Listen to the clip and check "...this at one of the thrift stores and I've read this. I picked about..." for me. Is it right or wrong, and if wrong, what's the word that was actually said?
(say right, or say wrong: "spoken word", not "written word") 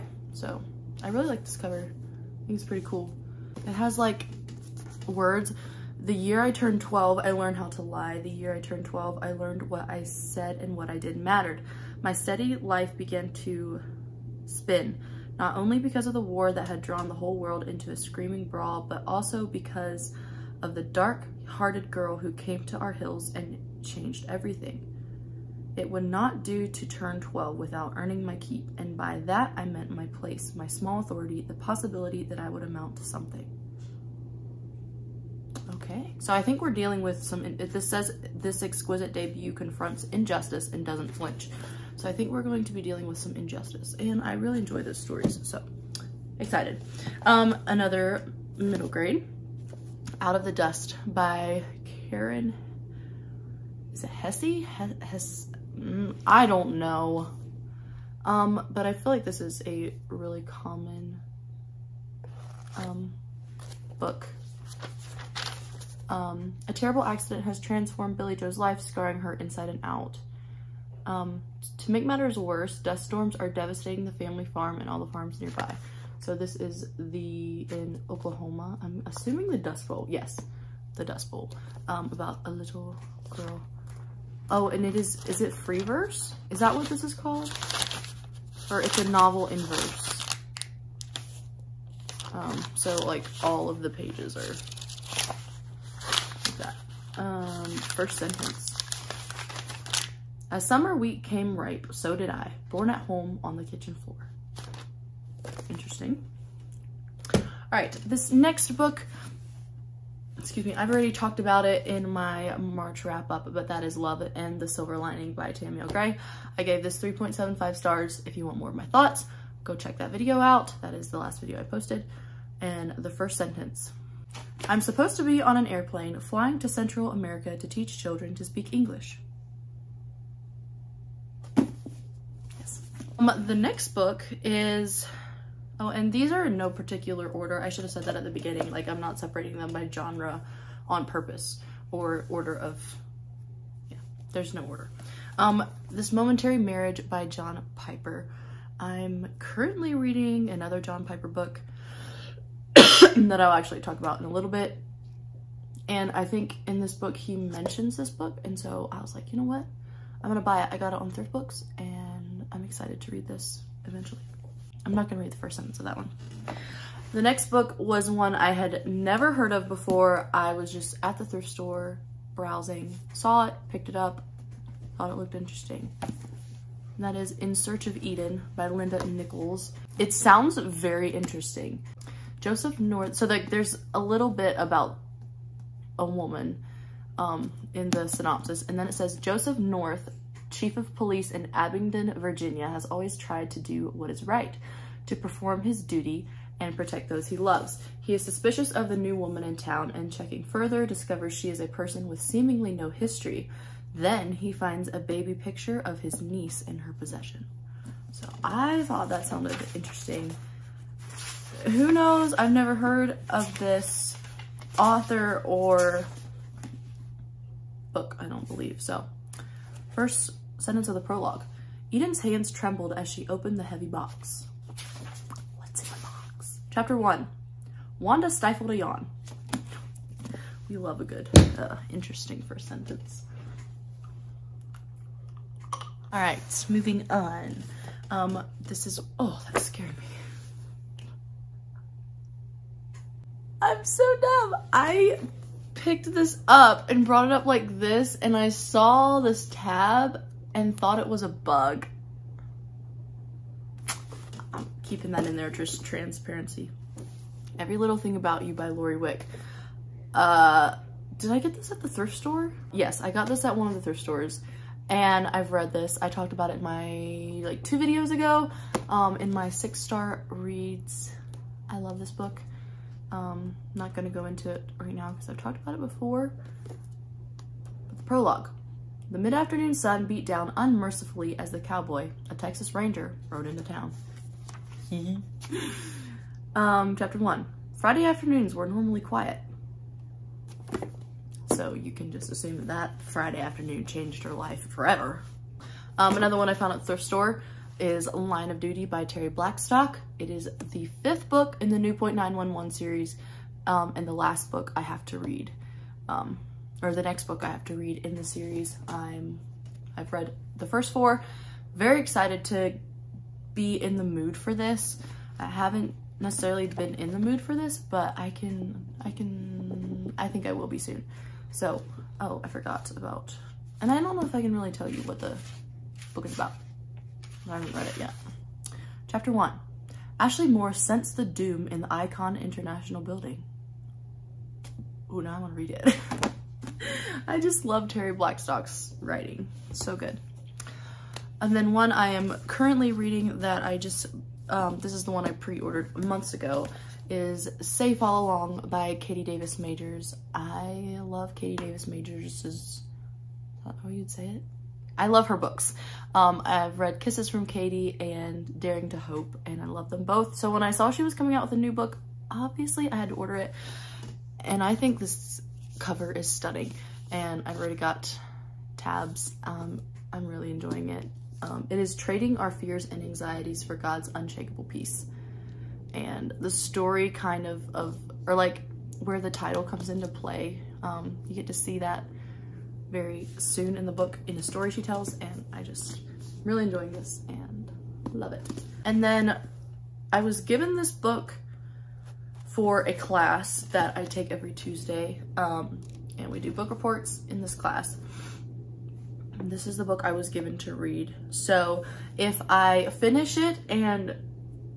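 wrong: "talked", not "picked".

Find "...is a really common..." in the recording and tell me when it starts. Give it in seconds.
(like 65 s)
59 s.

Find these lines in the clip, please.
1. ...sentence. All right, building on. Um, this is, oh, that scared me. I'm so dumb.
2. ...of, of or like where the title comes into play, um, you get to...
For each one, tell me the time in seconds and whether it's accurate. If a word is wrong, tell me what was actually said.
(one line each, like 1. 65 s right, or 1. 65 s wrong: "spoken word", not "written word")
1. 232 s wrong: "moving", not "building"
2. 377 s right.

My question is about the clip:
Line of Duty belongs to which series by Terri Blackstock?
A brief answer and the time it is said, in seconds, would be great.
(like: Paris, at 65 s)
Newpointe 911, at 301 s.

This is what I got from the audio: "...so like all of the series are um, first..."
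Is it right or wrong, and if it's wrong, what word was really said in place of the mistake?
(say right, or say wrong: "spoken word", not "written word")
wrong: "pages", not "series".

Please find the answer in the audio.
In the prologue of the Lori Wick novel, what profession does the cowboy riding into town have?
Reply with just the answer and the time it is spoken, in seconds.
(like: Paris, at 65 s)
Texas ranger, at 282 s.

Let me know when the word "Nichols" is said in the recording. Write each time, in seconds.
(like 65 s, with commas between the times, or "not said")
179 s.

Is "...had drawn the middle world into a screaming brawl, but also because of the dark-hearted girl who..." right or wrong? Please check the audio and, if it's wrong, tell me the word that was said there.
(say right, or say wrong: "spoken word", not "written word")
wrong: "whole", not "middle".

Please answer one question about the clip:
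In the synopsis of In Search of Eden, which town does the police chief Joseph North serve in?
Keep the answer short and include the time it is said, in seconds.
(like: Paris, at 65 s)
Abingdon, Virginia, at 191 s.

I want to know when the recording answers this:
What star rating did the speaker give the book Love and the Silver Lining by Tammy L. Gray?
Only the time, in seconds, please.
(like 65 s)
117 s.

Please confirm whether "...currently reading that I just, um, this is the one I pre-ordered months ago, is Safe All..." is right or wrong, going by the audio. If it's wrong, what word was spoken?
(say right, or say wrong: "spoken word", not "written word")
right.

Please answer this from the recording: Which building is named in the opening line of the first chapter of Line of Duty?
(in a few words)
Icon International.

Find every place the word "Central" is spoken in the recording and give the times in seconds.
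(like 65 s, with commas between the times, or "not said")
126 s.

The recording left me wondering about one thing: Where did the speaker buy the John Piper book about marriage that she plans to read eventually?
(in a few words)
Thrift Books.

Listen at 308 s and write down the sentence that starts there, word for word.
I'm, I've read the first four.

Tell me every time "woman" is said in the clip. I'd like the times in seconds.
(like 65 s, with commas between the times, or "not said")
186 s, 199 s.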